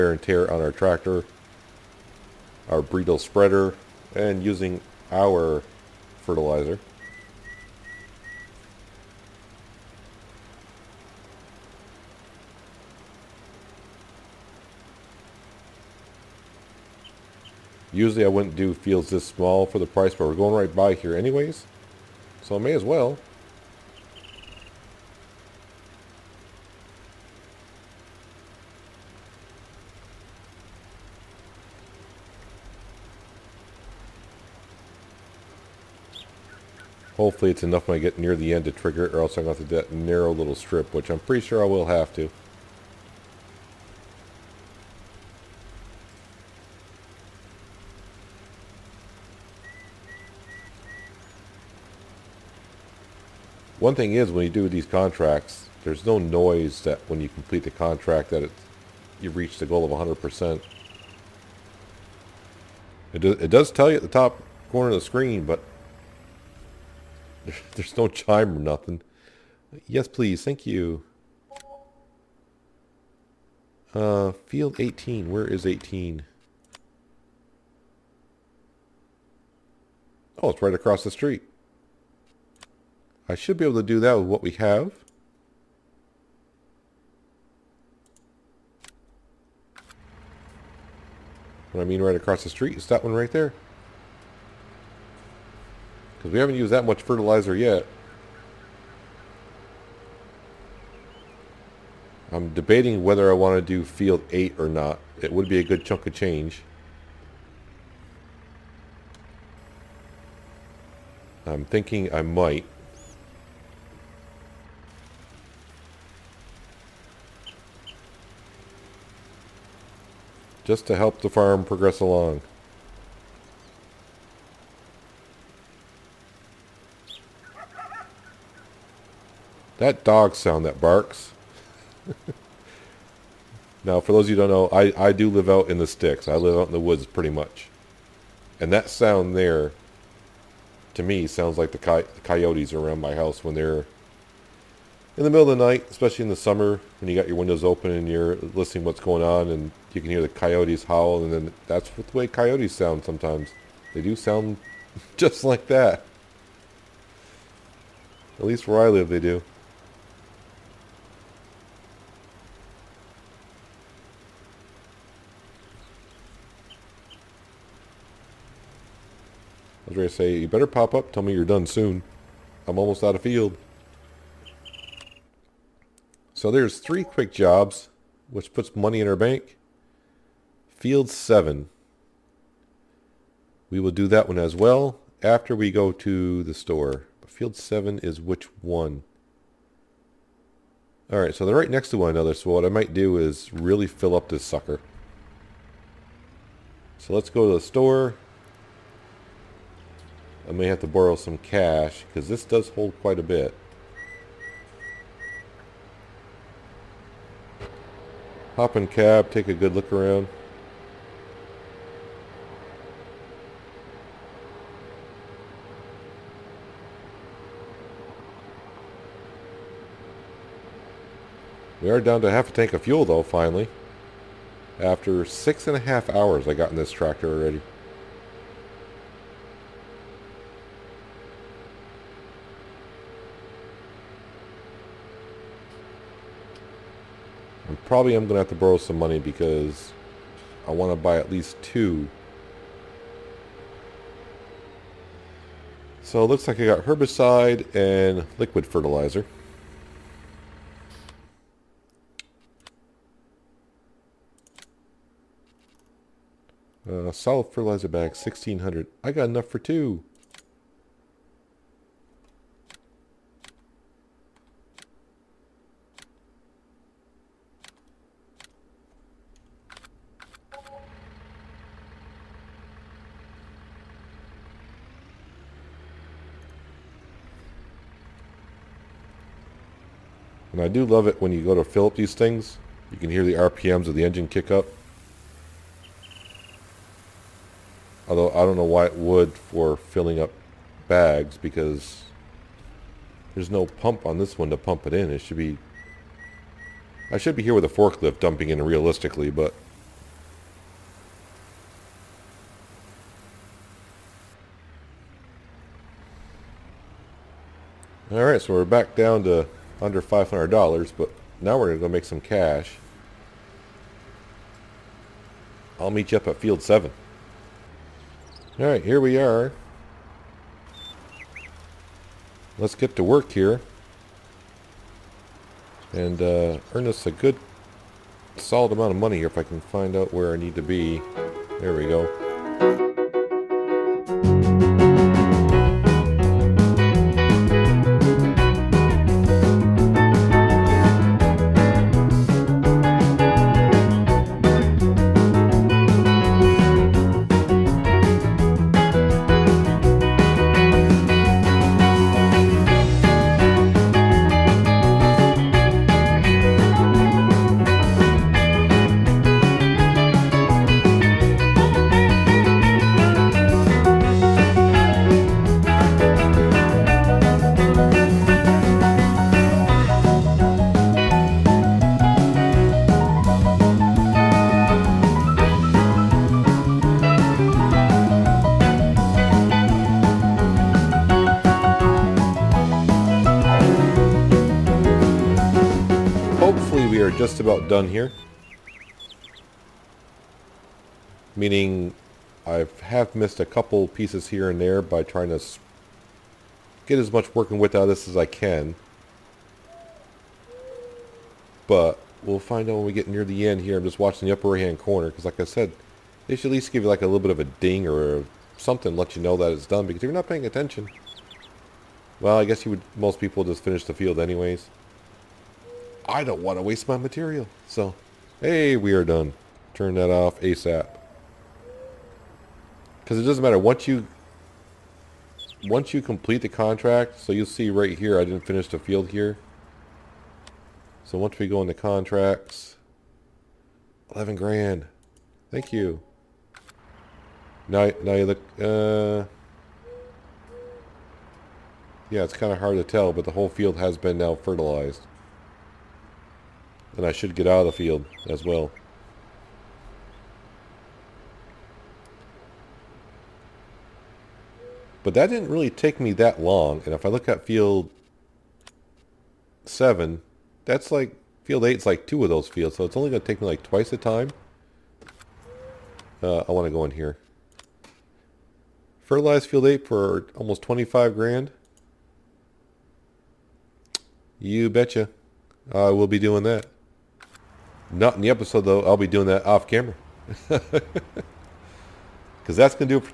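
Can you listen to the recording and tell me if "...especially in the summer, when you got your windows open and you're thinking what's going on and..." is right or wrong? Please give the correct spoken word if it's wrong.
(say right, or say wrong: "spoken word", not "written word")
wrong: "listening", not "thinking".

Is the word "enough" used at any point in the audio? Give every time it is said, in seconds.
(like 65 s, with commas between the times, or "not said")
37 s, 259 s.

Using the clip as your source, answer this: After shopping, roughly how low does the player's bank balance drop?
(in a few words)
Under $500.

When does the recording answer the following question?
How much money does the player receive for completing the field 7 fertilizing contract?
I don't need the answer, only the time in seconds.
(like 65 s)
434 s.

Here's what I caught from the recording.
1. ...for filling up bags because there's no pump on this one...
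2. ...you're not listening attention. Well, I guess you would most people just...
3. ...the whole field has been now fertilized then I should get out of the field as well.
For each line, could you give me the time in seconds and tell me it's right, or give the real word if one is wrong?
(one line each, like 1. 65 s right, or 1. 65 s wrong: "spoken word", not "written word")
1. 289 s right
2. 410 s wrong: "paying", not "listening"
3. 443 s right.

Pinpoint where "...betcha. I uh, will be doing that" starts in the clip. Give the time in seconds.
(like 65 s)
474 s.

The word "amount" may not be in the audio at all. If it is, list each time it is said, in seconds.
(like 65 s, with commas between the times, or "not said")
328 s.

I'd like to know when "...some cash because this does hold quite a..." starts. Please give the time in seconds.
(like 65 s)
201 s.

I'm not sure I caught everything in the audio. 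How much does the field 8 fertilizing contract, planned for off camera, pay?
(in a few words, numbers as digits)
Almost 25 grand.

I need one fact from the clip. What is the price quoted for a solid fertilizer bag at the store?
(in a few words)
1600.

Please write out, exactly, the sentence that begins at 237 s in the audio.
probably am going to have to borrow some money because I want to buy at least two.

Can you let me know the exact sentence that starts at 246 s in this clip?
So it looks like I got herbicide and liquid fertilizer.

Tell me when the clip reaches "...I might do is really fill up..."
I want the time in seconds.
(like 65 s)
192 s.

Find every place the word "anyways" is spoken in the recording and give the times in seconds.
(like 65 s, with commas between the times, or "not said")
21 s, 414 s.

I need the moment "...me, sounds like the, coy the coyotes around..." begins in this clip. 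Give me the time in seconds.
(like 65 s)
141 s.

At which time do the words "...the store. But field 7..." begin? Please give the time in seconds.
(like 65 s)
186 s.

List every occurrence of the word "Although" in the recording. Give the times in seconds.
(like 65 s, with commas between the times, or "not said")
288 s.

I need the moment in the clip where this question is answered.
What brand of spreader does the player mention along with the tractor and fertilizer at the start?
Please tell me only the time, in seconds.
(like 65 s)
2 s.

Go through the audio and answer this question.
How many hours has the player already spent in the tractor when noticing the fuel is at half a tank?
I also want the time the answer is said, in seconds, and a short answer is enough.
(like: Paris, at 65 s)
6.5, at 225 s.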